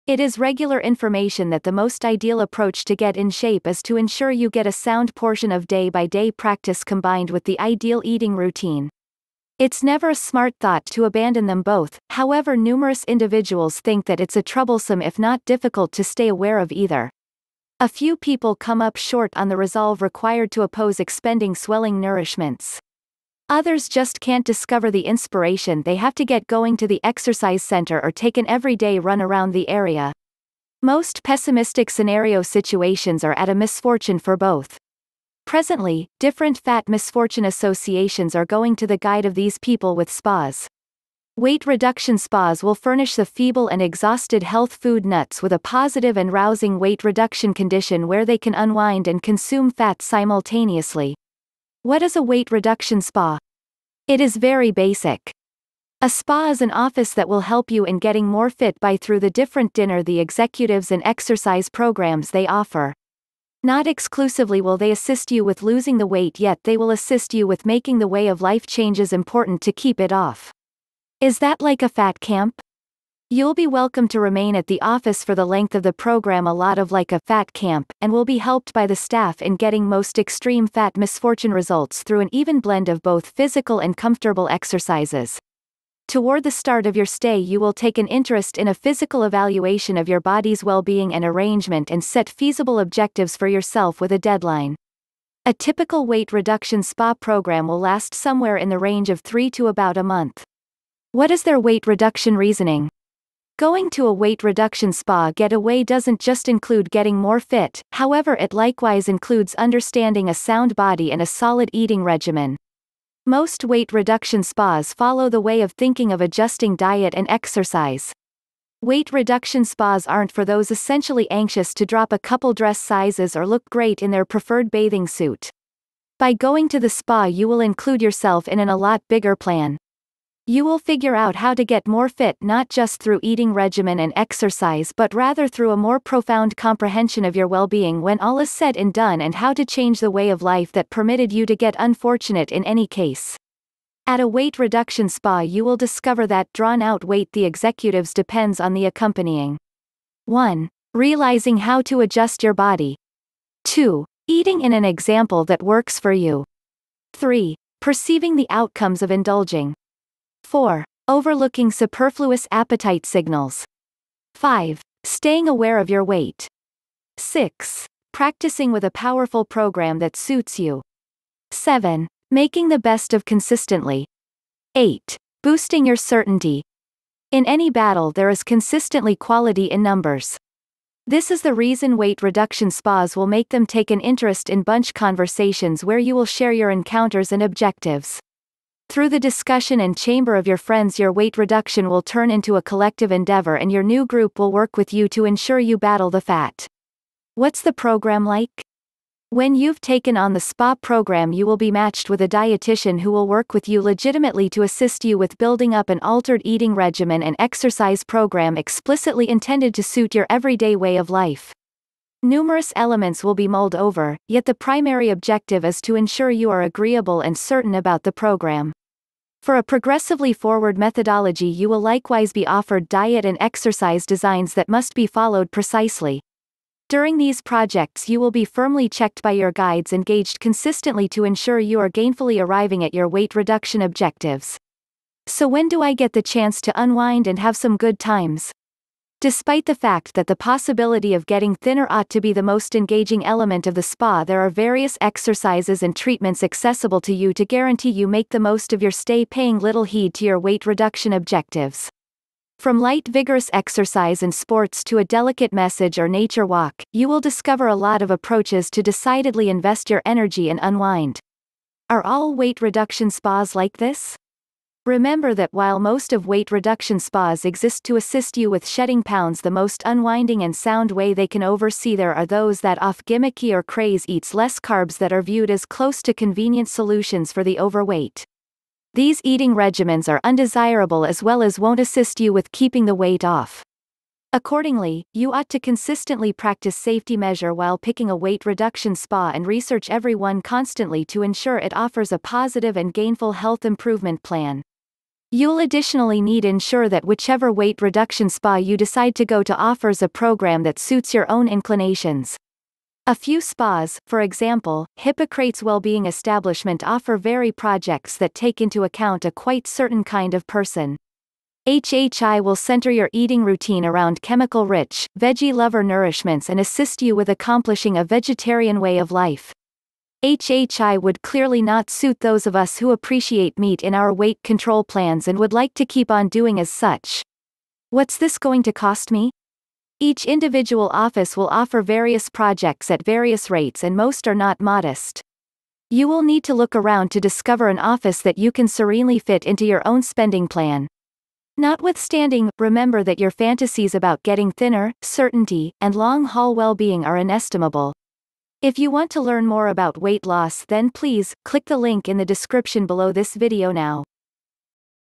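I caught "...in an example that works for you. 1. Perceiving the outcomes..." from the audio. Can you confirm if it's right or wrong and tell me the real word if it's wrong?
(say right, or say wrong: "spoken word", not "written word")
wrong: "3", not "1".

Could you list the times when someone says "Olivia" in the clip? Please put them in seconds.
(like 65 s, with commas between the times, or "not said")
not said.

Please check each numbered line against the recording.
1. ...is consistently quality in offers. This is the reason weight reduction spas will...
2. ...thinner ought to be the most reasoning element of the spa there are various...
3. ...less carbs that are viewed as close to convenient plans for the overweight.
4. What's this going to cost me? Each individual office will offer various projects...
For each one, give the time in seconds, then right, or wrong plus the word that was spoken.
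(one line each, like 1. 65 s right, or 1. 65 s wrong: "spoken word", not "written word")
1. 178 s wrong: "numbers", not "offers"
2. 241 s wrong: "engaging", not "reasoning"
3. 274 s wrong: "solutions", not "plans"
4. 327 s right.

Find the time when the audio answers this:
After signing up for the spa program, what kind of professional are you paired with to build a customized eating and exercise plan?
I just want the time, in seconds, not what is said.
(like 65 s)
202 s.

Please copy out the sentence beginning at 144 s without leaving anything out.
At a weight reduction spa you will discover that drawn out weight the executives depends on the accompanying.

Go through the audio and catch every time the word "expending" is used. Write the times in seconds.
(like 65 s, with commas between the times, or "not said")
20 s.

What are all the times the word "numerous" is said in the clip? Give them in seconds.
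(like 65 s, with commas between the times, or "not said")
12 s, 212 s.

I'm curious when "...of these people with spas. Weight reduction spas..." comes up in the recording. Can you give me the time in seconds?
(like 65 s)
39 s.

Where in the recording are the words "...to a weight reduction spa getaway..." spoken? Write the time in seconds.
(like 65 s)
103 s.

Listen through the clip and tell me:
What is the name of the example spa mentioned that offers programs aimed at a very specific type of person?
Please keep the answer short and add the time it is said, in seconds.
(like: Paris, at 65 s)
Hippocrates Wellbeing Establishment, at 304 s.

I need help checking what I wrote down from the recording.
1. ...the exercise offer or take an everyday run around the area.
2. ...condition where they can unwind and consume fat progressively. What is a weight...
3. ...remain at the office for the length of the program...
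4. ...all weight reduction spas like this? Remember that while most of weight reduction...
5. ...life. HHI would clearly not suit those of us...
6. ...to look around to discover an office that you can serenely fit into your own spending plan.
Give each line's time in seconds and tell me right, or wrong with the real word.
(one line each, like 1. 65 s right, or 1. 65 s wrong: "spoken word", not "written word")
1. 26 s wrong: "center", not "offer"
2. 47 s wrong: "simultaneously", not "progressively"
3. 74 s right
4. 262 s right
5. 319 s right
6. 336 s right.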